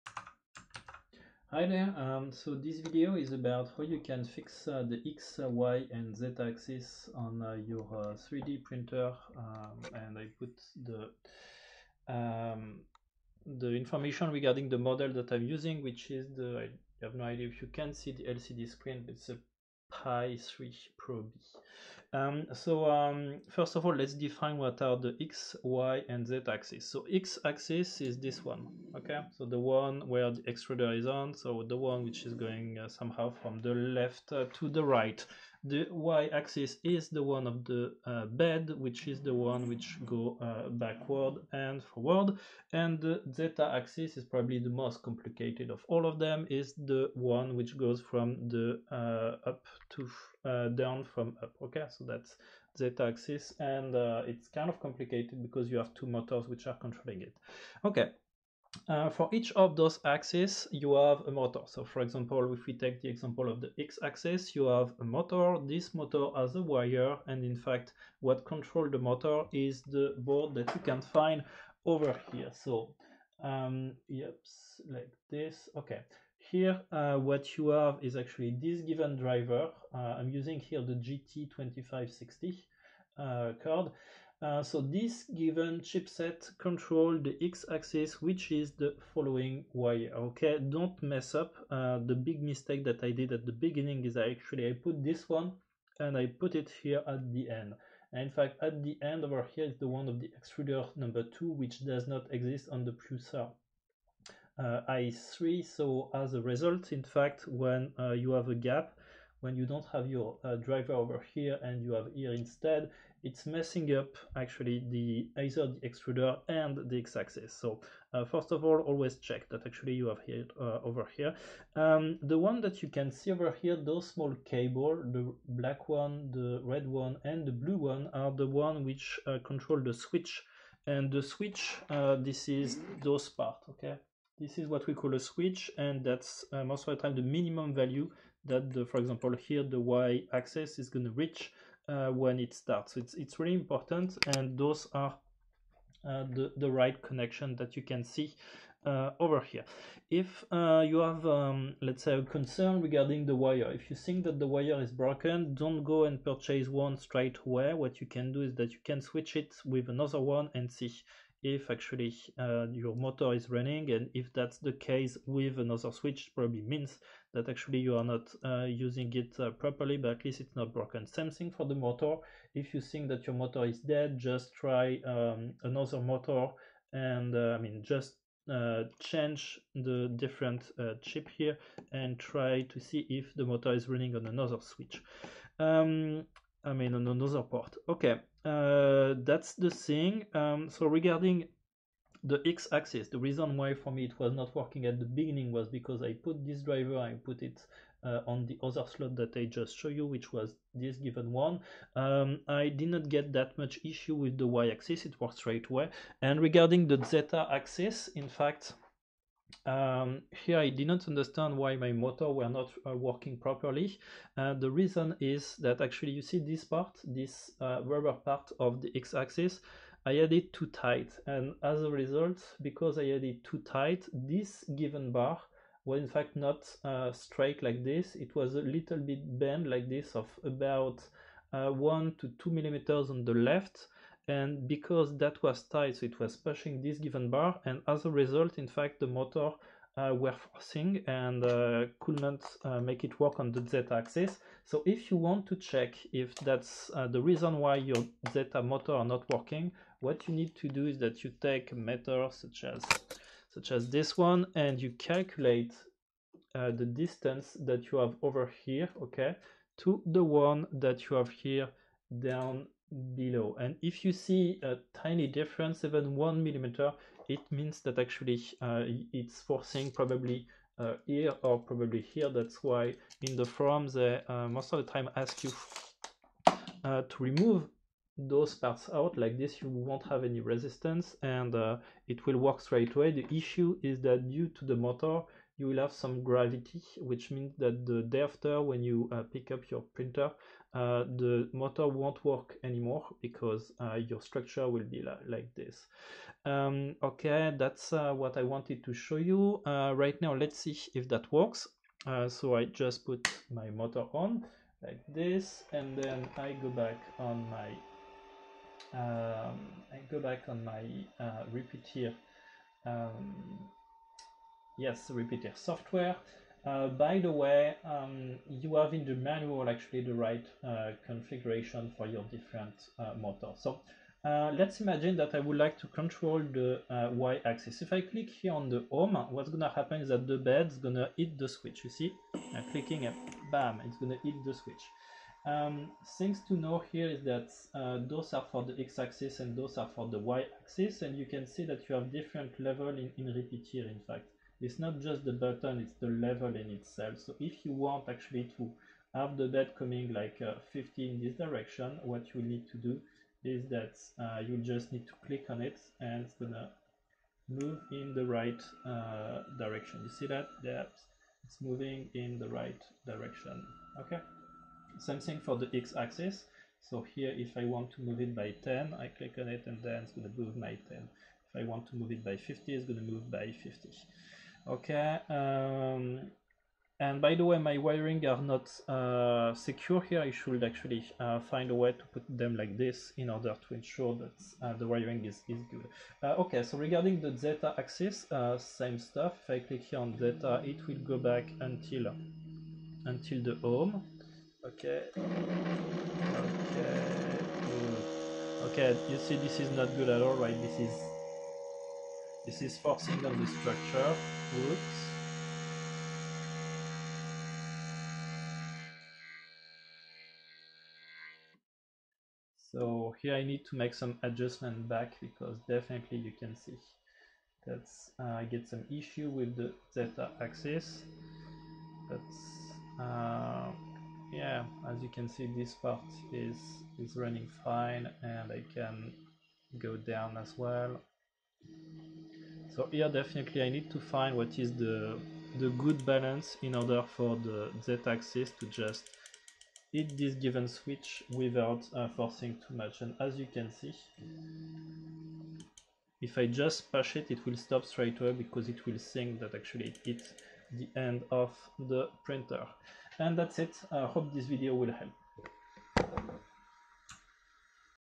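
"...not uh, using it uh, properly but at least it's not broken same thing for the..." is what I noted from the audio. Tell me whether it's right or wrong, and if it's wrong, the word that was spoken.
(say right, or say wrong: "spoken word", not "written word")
right.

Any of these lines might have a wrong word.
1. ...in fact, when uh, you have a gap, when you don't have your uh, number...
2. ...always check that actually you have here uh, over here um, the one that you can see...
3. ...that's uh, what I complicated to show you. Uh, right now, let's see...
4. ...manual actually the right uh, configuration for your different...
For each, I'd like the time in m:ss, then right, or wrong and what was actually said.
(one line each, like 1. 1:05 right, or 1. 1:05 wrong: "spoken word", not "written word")
1. 1:46 wrong: "driver", not "number"
2. 1:58 right
3. 4:57 wrong: "wanted", not "complicated"
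4. 5:19 right.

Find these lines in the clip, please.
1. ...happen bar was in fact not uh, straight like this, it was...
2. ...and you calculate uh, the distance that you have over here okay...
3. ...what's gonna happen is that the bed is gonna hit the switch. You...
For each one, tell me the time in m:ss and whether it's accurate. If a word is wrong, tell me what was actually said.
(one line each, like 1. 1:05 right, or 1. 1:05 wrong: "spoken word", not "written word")
1. 3:44 wrong: "given", not "happen"
2. 4:14 right
3. 5:29 right.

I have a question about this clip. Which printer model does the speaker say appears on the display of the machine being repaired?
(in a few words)
Pi 3 Pro B.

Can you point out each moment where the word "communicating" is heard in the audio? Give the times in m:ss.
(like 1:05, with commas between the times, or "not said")
not said.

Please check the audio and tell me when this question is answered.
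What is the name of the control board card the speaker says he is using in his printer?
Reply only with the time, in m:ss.
1:20.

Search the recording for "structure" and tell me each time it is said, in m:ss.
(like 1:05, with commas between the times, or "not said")
4:54, 6:43.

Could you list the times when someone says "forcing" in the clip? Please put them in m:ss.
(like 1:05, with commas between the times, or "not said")
4:00, 4:29, 6:42, 7:22.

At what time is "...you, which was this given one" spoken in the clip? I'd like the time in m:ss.
3:19.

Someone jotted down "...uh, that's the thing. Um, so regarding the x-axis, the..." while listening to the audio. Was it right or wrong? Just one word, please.
right.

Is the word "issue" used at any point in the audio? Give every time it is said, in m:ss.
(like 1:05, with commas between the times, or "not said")
3:23, 4:43, 6:58.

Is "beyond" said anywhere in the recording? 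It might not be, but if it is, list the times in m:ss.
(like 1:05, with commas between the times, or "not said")
not said.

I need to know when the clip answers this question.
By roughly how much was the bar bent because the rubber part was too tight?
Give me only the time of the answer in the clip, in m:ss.
3:51.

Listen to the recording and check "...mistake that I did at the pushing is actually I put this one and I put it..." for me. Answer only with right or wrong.
wrong.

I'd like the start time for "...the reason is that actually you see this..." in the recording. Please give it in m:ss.
3:34.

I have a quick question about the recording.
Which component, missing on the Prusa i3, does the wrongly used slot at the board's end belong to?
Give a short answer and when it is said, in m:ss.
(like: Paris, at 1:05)
extruder number two, at 1:40.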